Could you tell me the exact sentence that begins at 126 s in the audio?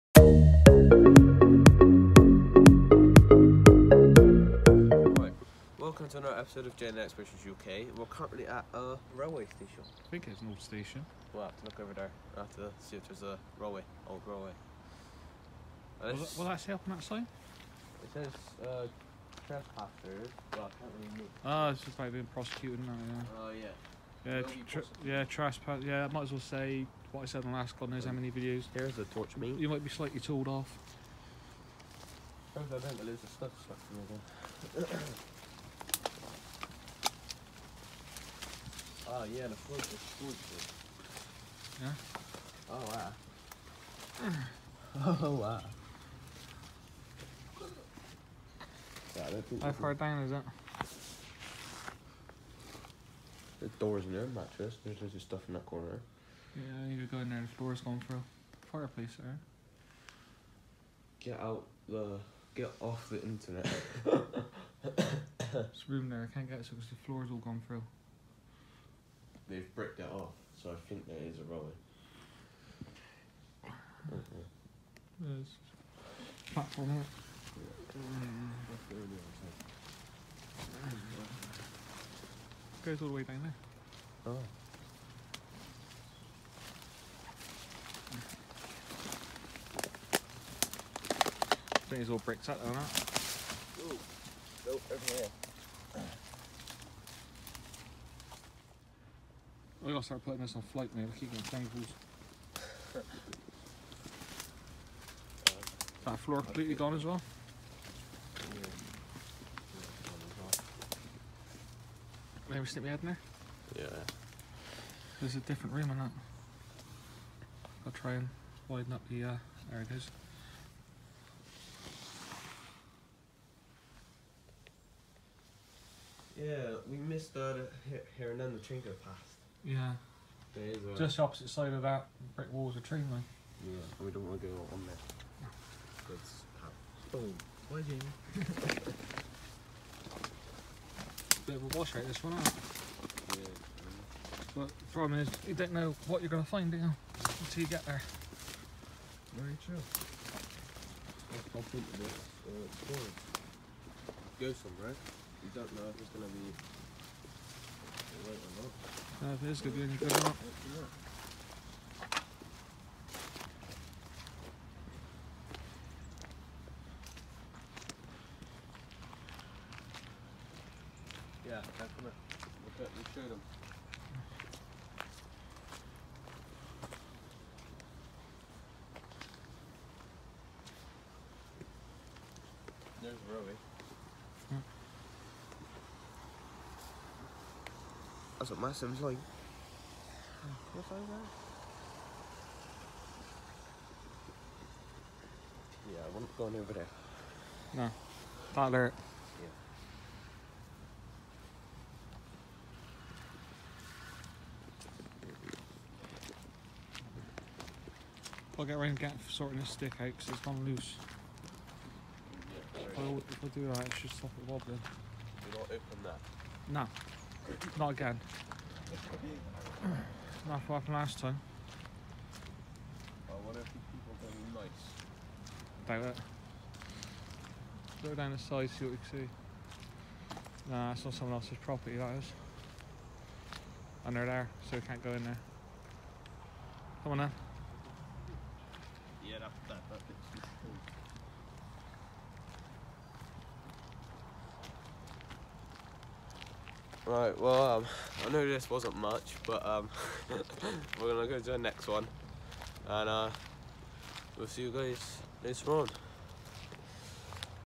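Yeah, we missed and uh, the Trinco past.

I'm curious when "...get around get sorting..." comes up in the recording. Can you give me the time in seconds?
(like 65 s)
208 s.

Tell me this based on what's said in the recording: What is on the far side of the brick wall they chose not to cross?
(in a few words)
A tree line.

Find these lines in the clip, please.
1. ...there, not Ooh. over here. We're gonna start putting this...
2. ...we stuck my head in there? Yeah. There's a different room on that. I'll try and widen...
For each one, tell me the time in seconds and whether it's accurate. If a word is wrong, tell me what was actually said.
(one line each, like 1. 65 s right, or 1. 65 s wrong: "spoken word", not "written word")
1. 92 s right
2. 112 s wrong: "stick", not "stuck".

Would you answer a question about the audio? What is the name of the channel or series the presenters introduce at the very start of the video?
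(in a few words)
JN Explorations UK.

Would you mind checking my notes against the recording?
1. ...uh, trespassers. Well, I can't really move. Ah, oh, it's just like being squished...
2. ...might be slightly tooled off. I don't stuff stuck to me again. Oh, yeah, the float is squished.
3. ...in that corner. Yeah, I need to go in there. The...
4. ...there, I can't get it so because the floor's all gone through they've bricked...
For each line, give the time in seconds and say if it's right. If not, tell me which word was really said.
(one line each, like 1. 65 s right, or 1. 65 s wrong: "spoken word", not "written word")
1. 18 s wrong: "prosecuted", not "squished"
2. 29 s right
3. 55 s right
4. 66 s right.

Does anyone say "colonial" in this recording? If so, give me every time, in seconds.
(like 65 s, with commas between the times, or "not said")
not said.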